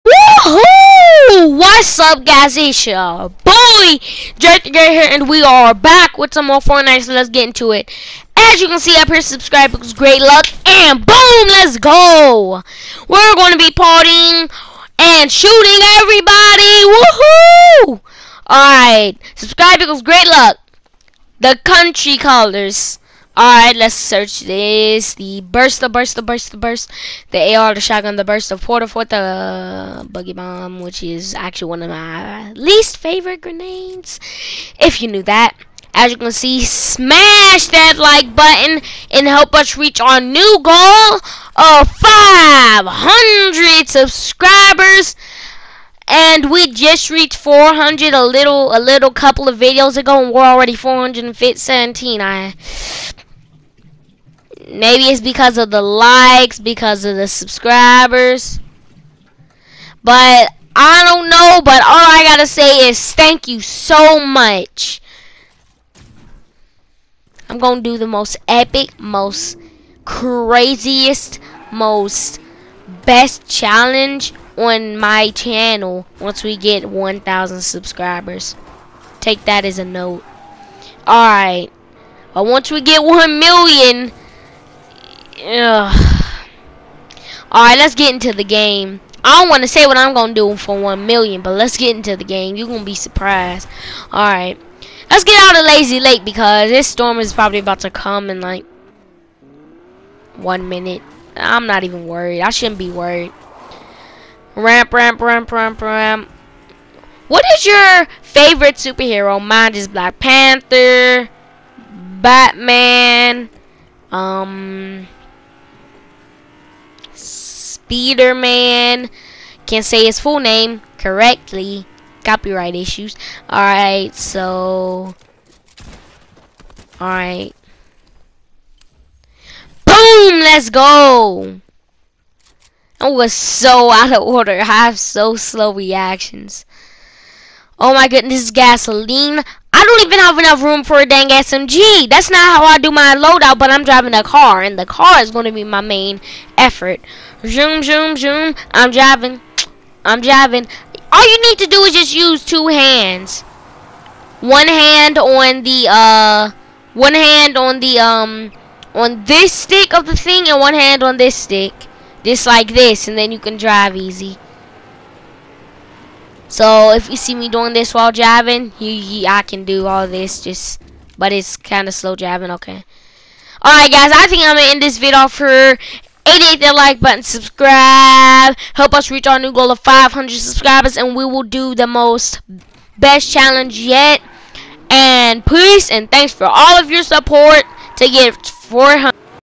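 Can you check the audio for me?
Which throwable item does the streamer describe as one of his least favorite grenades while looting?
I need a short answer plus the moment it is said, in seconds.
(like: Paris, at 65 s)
boogie bomb, at 30 s.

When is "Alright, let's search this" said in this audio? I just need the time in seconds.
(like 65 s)
23 s.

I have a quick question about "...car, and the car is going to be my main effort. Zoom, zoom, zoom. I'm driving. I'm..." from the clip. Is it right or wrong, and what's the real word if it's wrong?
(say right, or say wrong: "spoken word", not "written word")
right.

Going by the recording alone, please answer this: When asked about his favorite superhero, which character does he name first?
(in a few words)
Black Panther.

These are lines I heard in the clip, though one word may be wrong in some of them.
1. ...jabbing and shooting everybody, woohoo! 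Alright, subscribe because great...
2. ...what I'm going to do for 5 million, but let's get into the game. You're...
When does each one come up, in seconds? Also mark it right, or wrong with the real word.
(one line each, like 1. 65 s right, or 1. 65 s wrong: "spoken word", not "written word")
1. 13 s wrong: "partying", not "jabbing"
2. 89 s wrong: "1", not "5".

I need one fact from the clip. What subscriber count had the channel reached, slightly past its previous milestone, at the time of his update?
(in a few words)
417.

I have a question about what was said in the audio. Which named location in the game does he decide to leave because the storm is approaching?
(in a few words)
Lazy Lake.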